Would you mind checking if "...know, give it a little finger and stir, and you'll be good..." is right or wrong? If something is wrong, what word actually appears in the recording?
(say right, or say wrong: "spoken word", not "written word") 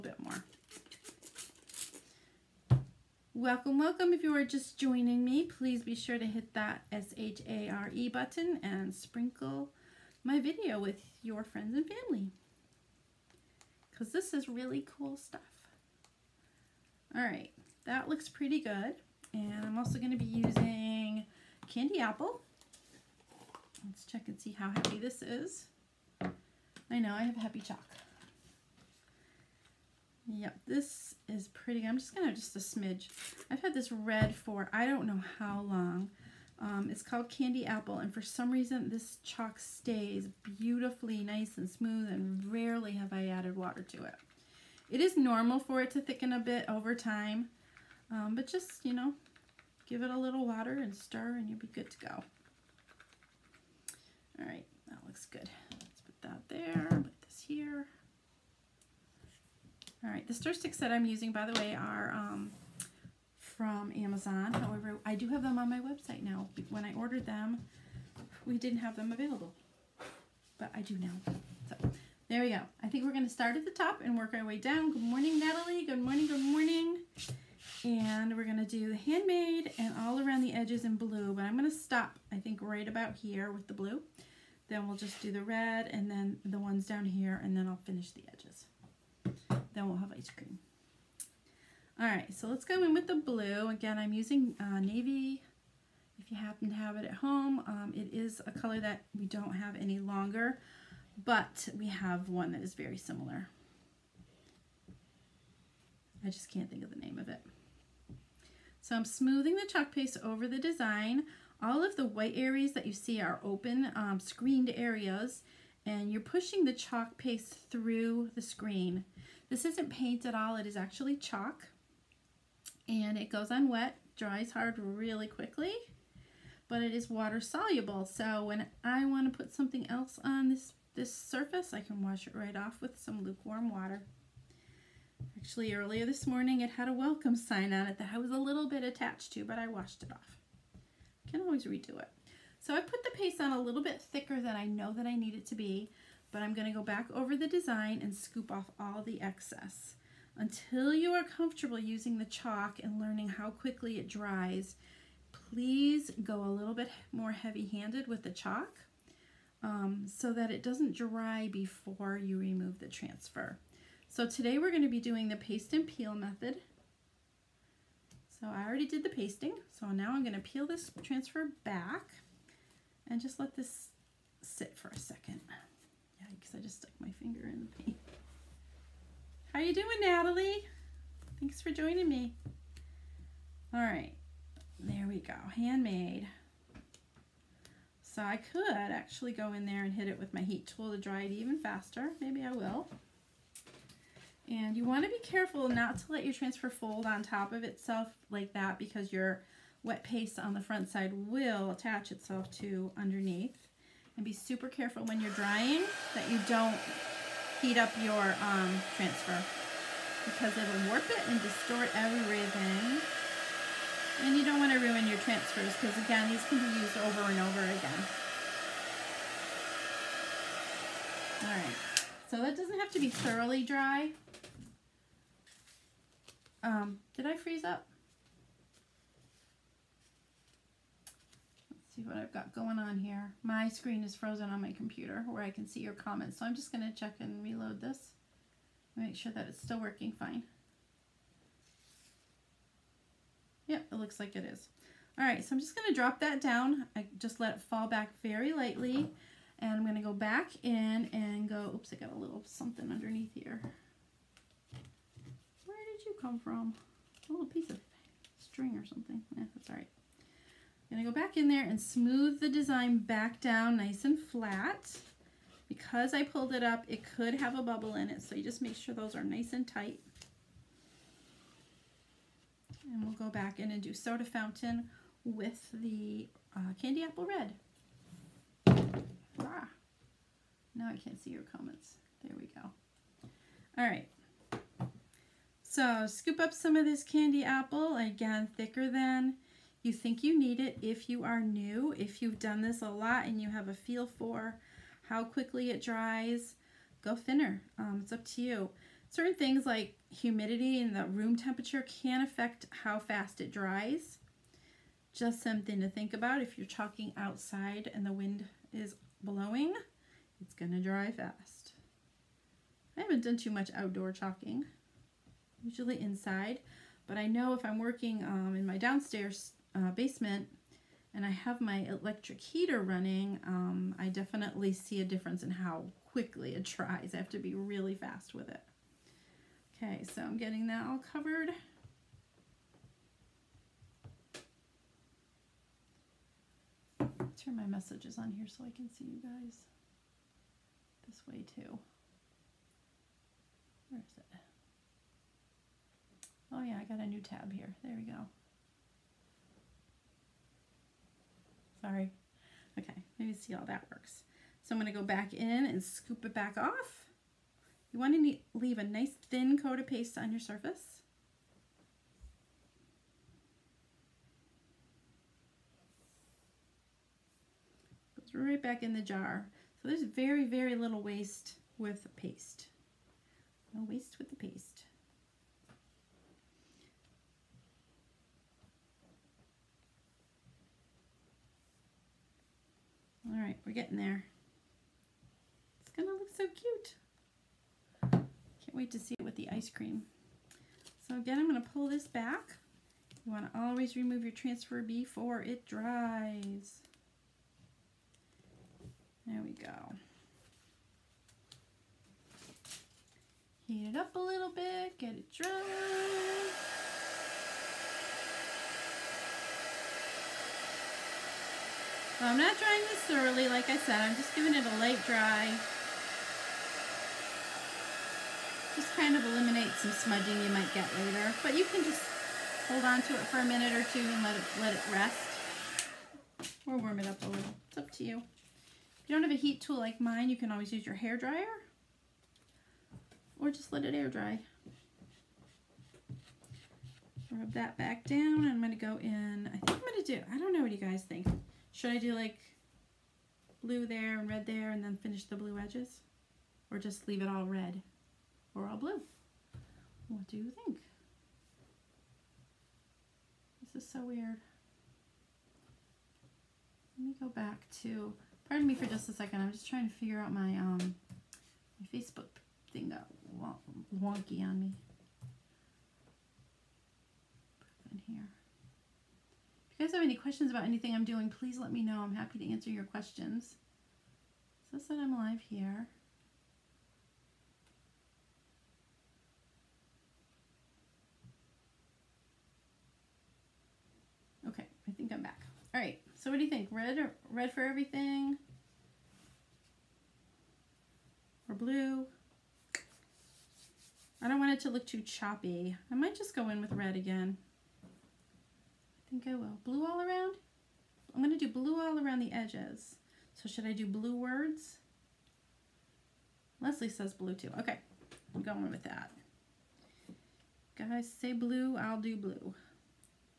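wrong: "water", not "finger".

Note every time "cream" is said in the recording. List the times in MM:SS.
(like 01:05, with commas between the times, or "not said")
01:30, 06:29.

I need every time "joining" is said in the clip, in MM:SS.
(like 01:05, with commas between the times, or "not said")
00:04, 03:01.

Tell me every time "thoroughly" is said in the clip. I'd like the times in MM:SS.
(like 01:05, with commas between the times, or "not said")
03:43, 06:53.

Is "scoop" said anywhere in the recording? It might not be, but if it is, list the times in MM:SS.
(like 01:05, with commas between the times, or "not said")
02:28, 04:46, 05:55.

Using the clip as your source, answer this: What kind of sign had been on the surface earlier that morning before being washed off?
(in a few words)
A welcome sign.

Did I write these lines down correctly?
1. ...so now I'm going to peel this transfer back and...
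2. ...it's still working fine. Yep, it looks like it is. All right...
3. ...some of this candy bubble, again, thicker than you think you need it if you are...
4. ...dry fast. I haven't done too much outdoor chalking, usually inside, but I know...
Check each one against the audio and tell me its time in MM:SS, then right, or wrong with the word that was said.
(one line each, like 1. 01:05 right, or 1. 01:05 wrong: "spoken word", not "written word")
1. 02:49 right
2. 03:59 right
3. 04:46 wrong: "apple", not "bubble"
4. 05:10 right.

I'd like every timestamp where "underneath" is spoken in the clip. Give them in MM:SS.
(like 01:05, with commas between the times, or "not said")
03:22, 04:12.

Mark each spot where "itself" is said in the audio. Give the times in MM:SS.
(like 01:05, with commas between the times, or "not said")
03:17, 03:22.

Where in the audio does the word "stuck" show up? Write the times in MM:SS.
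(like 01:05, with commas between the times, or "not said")
02:56.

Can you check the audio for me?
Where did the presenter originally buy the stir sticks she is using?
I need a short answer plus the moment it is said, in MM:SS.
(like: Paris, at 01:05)
Amazon, at 01:04.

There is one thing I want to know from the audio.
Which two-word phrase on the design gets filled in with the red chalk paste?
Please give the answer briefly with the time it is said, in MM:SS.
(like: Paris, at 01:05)
Soda fountain, at 04:33.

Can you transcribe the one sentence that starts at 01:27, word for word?
And then I'll finish the edges.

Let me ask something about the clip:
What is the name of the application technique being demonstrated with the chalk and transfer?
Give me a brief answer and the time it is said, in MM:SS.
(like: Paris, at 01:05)
Paste and peel, at 02:45.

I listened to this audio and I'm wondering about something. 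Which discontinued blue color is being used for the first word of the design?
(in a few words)
Navy.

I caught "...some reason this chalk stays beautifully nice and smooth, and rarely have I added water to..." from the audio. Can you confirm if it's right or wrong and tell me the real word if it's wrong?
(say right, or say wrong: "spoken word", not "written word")
right.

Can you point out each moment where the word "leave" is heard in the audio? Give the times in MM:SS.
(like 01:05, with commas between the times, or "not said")
05:58, 07:27.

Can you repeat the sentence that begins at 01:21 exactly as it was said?
But I'm going to stop, I think, right about here with the blue.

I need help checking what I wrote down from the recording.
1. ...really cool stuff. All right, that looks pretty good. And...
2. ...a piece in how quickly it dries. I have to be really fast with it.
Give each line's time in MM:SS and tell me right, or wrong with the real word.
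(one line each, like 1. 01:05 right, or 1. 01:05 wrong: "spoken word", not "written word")
1. 00:14 right
2. 05:25 wrong: "difference", not "piece".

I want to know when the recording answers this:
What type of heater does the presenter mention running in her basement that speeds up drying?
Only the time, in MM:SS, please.
05:21.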